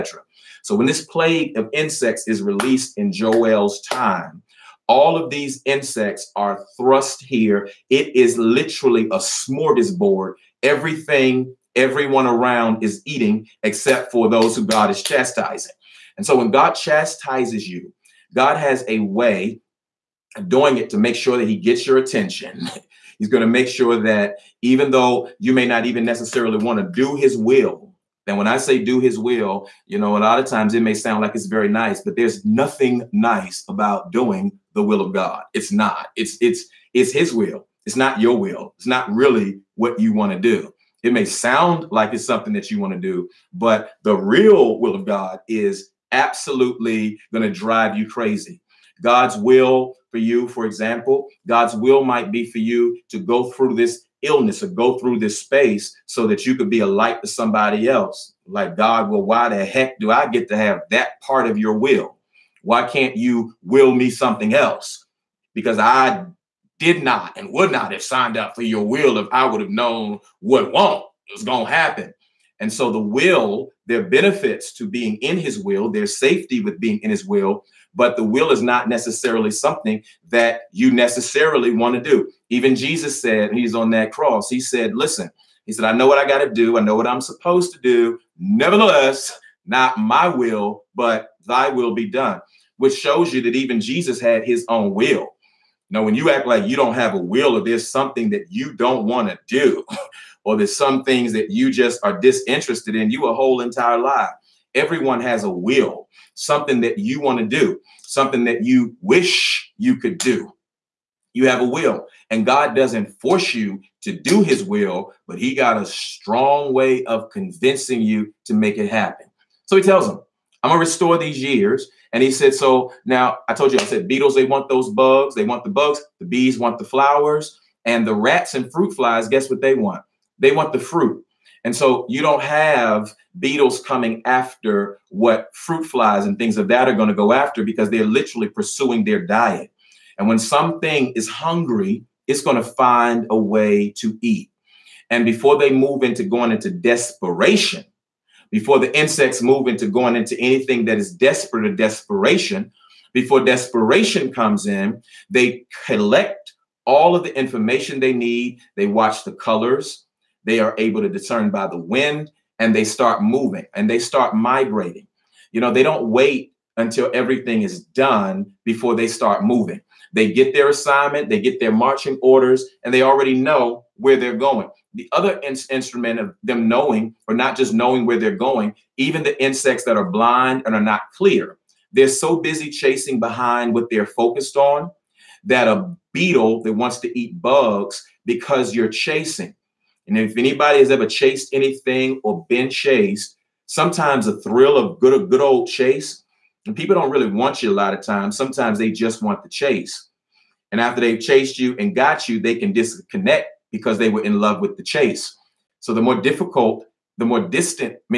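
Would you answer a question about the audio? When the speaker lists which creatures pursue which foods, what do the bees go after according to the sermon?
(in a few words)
The flowers.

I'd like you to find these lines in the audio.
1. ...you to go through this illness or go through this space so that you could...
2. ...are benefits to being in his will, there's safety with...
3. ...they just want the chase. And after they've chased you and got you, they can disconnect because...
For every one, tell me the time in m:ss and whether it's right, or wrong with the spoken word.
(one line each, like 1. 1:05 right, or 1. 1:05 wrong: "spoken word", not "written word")
1. 0:52 right
2. 1:14 right
3. 3:18 right.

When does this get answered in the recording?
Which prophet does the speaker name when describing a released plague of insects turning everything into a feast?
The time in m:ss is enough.
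0:03.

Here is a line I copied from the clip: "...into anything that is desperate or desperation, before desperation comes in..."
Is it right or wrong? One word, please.
right.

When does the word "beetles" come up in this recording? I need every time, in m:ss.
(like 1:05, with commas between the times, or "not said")
2:04, 2:13, 3:06.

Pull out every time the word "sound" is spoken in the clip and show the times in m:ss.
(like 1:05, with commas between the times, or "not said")
0:30, 0:41.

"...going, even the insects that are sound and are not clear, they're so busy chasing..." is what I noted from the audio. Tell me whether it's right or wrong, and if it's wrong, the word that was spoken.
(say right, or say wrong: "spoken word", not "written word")
wrong: "blind", not "sound".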